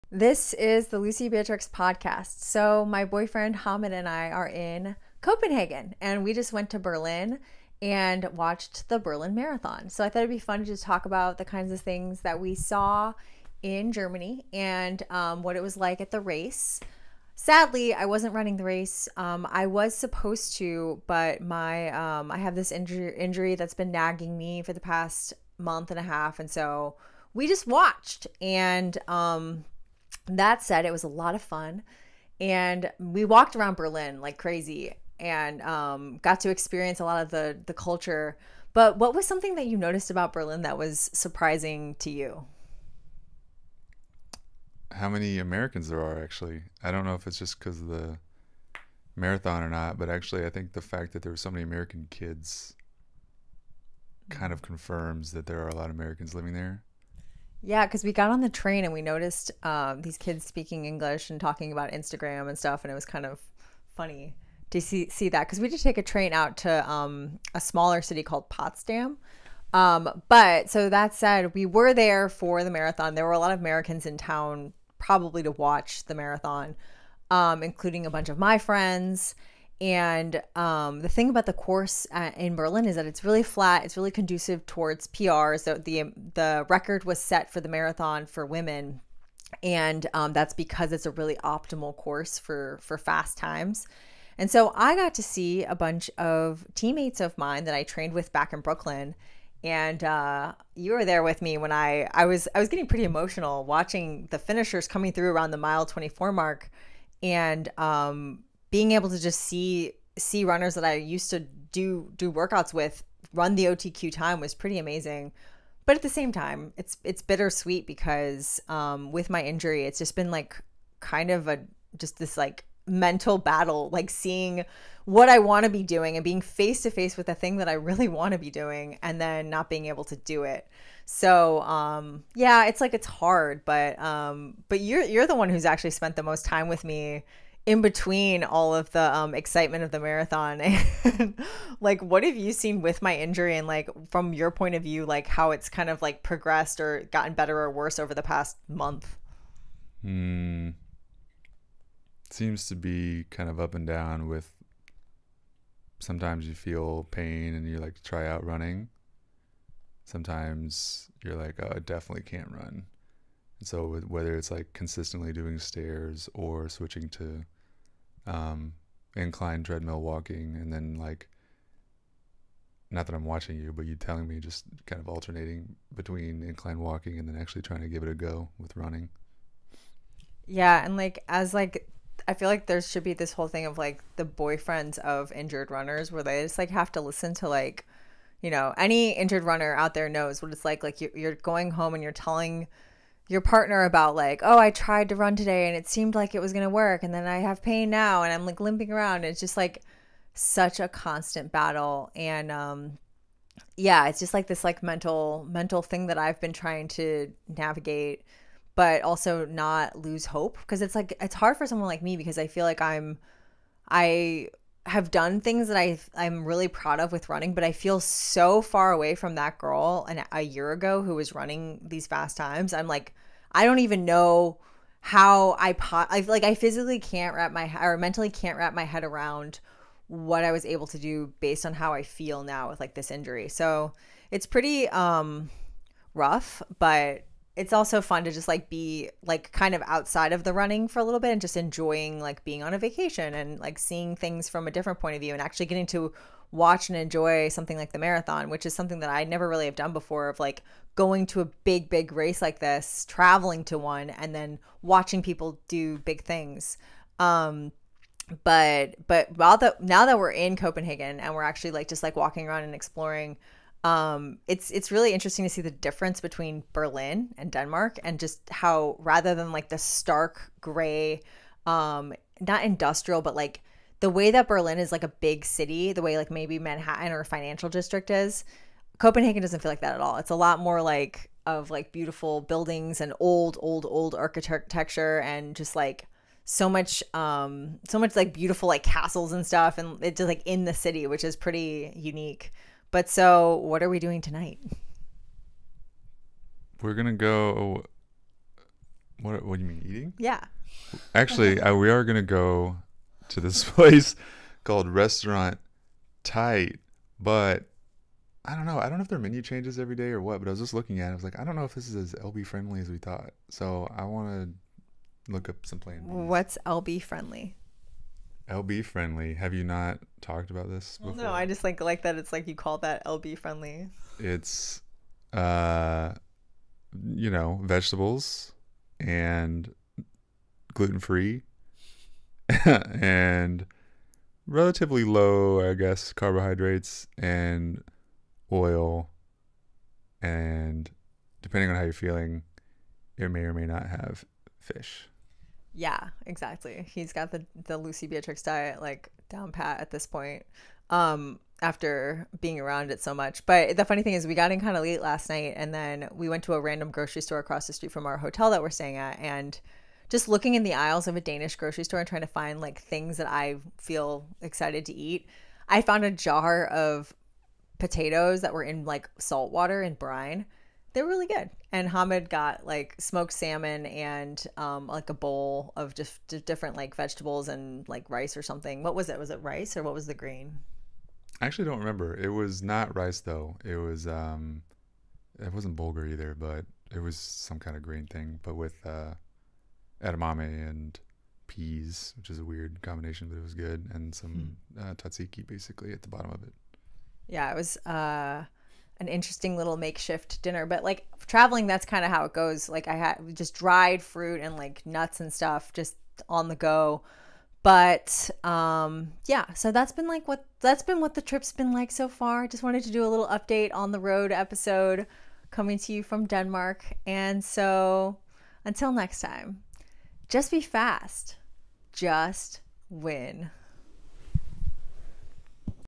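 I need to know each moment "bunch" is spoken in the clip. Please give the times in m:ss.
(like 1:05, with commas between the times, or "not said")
1:18, 1:35.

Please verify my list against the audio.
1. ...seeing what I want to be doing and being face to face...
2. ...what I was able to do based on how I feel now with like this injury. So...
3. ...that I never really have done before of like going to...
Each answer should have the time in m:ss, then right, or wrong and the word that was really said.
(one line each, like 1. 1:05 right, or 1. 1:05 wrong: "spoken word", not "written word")
1. 2:04 right
2. 3:50 right
3. 4:08 right.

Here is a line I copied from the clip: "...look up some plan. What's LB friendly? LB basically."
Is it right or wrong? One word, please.
wrong.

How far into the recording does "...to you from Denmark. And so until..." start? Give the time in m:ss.
6:55.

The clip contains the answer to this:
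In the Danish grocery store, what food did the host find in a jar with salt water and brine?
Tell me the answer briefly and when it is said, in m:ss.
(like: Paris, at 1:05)
Potatoes, at 6:07.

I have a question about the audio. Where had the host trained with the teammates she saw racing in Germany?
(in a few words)
Brooklyn.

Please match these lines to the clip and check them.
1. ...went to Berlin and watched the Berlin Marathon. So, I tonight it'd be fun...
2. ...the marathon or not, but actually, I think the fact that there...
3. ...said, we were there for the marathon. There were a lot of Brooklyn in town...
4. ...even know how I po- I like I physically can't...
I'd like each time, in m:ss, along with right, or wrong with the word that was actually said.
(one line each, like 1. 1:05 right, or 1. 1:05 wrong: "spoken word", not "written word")
1. 0:06 wrong: "thought", not "tonight"
2. 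0:47 right
3. 1:11 wrong: "Americans", not "Brooklyn"
4. 3:43 right.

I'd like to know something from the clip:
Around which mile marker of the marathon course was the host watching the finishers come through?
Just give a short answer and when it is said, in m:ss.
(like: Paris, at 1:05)
24, at 1:45.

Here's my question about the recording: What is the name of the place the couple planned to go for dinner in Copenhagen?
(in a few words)
Restaurant Tight.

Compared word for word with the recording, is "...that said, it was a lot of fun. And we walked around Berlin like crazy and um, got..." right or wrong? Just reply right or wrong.
right.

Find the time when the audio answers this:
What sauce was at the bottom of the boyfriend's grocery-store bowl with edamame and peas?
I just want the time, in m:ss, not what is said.
6:34.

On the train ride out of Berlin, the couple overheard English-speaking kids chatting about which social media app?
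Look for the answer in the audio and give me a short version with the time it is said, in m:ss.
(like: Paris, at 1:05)
Instagram, at 1:01.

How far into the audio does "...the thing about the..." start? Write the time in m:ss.
1:20.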